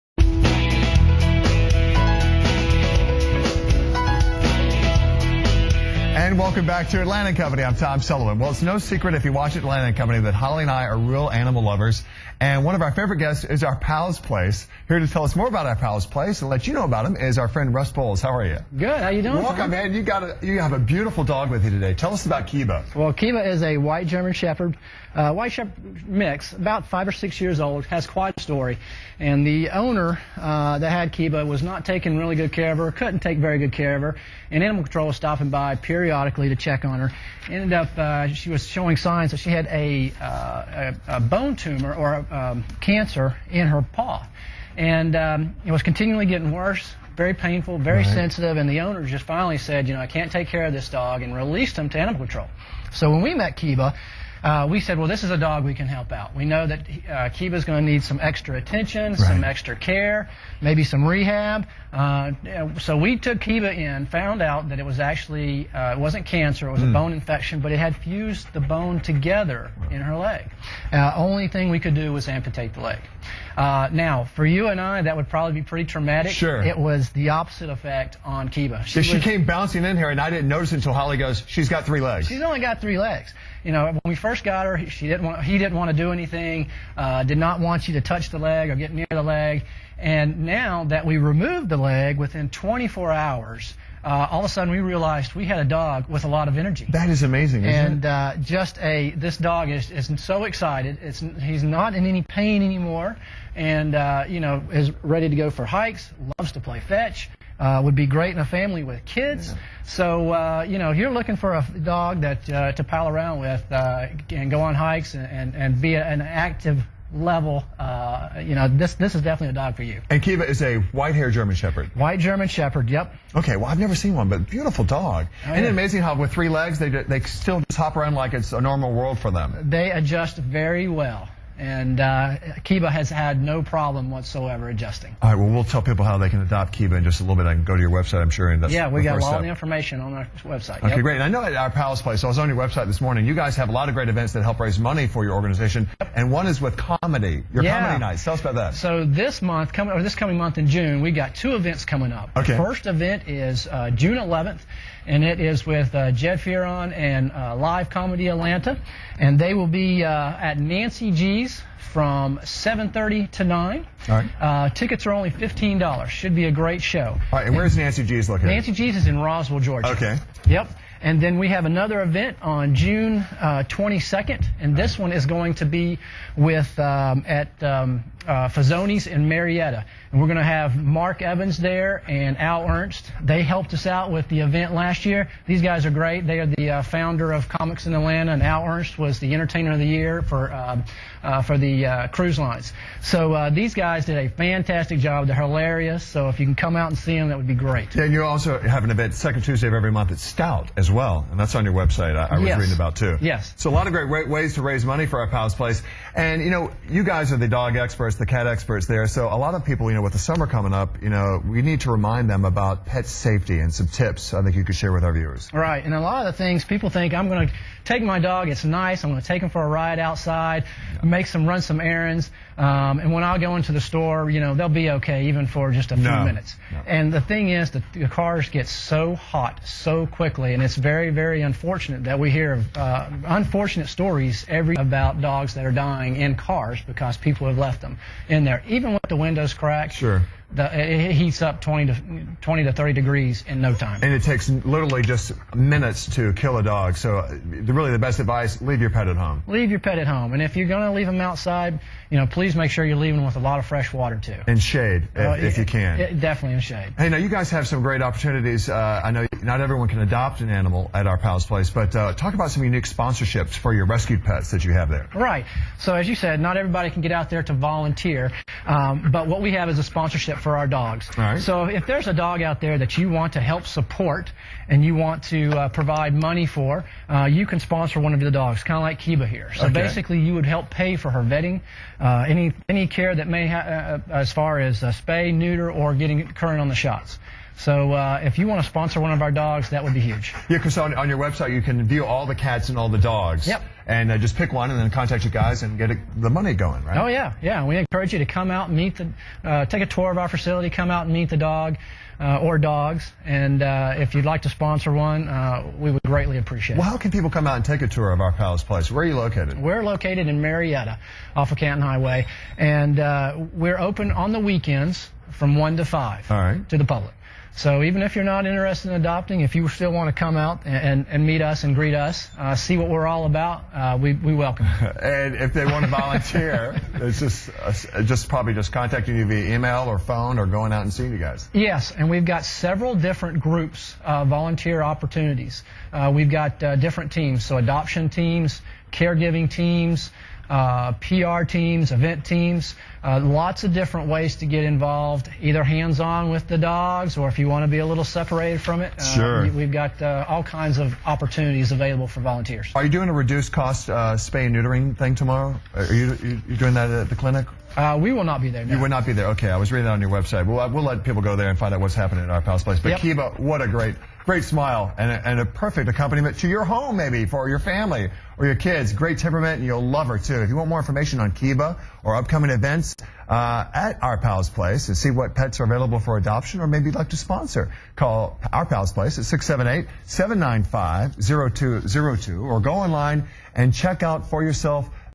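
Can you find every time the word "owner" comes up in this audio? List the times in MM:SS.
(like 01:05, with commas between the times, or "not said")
00:29, 00:48.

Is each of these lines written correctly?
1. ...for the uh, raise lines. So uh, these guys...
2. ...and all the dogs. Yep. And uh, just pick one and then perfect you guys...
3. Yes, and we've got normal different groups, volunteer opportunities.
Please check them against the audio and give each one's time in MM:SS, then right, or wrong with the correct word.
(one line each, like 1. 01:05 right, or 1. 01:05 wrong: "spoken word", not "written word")
1. 03:11 wrong: "cruise", not "raise"
2. 04:52 wrong: "contact", not "perfect"
3. 05:31 wrong: "several", not "normal".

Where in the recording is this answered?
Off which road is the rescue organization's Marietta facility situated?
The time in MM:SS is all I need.
05:11.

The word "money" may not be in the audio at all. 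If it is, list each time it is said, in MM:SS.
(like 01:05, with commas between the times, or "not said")
02:24, 03:24, 04:36, 04:56.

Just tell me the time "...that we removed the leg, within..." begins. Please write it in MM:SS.
01:30.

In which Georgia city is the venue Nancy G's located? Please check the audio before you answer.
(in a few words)
Roswell.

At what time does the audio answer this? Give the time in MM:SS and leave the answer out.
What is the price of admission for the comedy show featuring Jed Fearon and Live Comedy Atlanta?
02:45.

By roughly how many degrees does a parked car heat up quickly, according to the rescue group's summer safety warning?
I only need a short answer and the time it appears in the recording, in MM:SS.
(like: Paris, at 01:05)
20 to 30 degrees, at 04:02.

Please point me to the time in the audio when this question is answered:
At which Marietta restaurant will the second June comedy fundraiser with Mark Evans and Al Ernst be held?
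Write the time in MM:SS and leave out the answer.
02:58.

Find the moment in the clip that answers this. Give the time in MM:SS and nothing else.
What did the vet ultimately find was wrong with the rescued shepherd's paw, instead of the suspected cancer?
01:06.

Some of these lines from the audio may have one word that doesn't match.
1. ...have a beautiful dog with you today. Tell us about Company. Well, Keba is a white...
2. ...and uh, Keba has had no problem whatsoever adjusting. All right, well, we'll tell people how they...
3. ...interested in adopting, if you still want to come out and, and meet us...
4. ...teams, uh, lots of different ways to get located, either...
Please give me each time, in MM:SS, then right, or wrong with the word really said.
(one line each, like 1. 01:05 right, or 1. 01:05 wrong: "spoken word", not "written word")
1. 00:20 wrong: "Keba", not "Company"
2. 02:11 right
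3. 05:18 right
4. 05:42 wrong: "involved", not "located".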